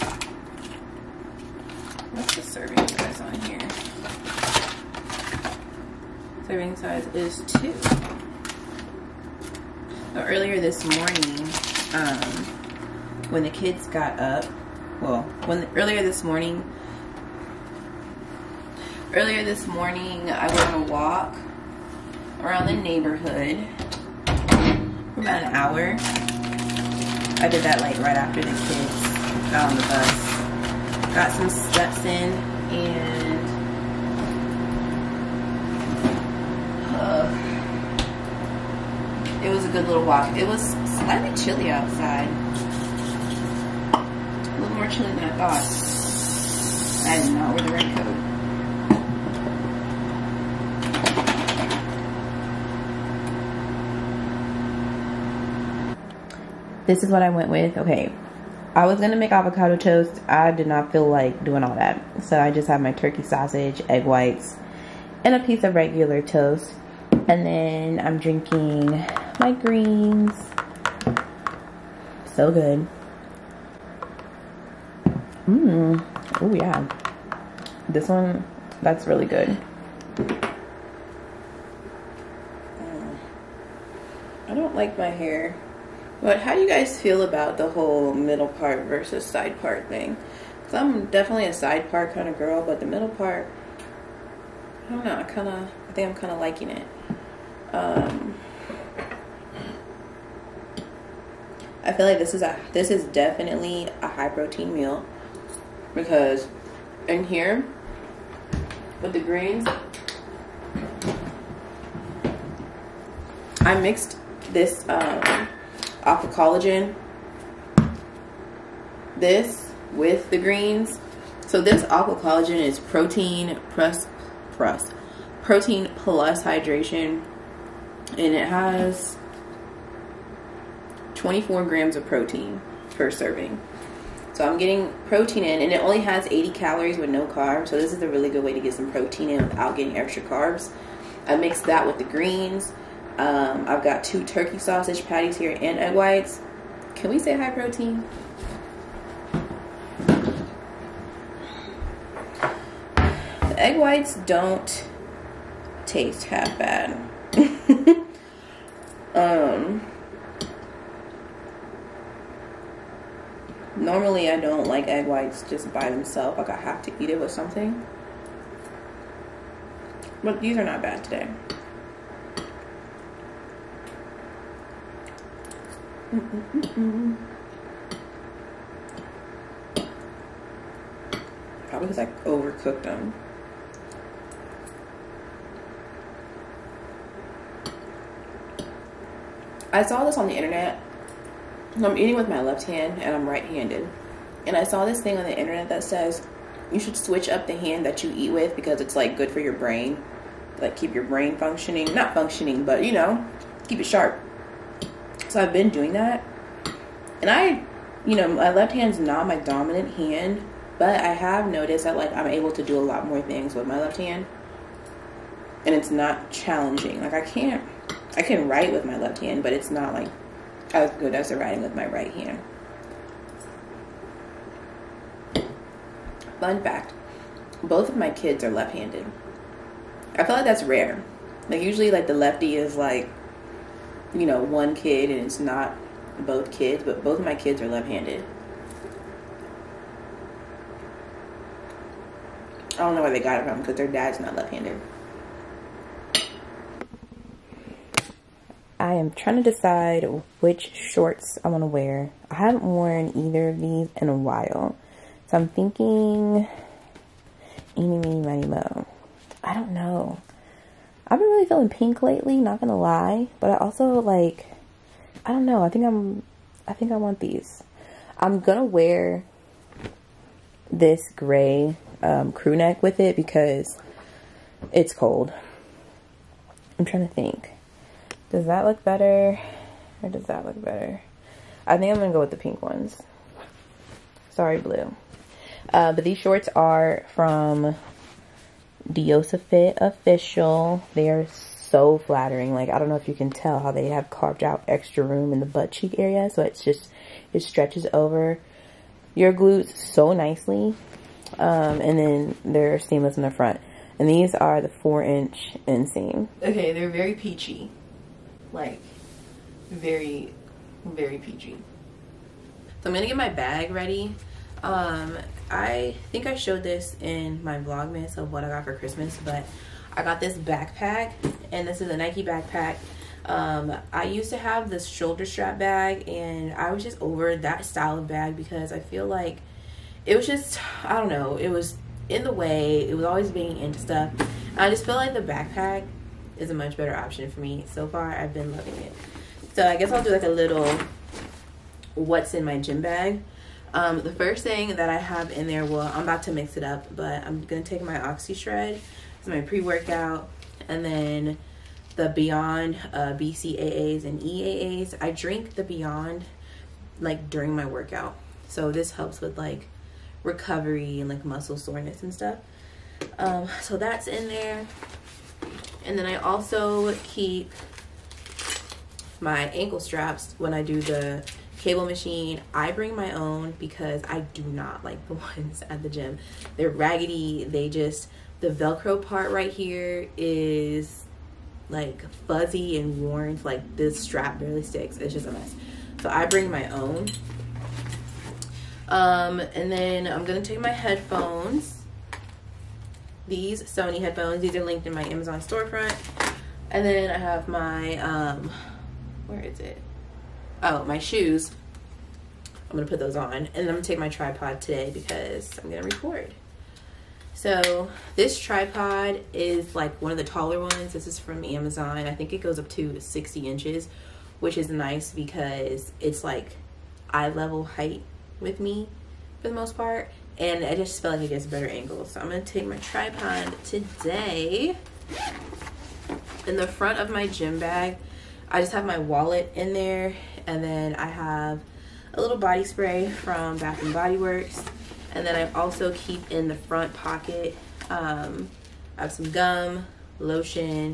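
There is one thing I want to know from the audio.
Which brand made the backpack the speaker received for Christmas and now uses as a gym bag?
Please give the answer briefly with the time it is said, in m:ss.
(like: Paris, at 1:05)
Nike, at 5:21.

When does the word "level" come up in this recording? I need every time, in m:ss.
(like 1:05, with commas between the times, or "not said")
6:57.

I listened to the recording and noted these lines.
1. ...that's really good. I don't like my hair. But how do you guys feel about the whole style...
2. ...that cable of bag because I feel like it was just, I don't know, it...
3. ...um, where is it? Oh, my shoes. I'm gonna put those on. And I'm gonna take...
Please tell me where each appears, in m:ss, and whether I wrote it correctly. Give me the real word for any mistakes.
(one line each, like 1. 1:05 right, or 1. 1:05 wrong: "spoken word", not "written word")
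1. 1:18 wrong: "middle", not "style"
2. 5:27 wrong: "style", not "cable"
3. 6:37 right.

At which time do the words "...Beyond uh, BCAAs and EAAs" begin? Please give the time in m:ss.
5:52.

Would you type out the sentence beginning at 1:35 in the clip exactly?
I kind of, I think I'm kind of liking it.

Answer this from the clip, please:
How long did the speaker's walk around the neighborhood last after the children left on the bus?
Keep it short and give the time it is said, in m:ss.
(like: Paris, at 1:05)
about an hour, at 0:25.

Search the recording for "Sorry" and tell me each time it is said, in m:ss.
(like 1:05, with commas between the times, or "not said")
4:44.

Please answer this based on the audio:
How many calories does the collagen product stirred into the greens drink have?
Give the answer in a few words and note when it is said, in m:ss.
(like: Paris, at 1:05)
80, at 2:16.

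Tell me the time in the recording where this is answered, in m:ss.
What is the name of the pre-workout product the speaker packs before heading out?
5:47.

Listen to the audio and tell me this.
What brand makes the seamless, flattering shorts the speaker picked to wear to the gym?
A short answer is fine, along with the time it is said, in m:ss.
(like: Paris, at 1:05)
Diosa Fit Official, at 4:48.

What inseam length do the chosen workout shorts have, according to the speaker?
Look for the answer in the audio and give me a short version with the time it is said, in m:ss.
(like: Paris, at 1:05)
4 inch, at 5:04.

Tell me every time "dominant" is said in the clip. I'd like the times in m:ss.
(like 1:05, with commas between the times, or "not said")
3:29.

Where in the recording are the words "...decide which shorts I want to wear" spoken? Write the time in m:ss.
4:09.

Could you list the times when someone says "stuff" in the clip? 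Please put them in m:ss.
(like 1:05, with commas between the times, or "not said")
5:33, 6:02.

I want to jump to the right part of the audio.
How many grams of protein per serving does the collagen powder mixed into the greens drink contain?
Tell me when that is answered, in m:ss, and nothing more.
2:11.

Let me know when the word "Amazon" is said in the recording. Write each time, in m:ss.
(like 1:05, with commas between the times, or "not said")
6:35, 6:51.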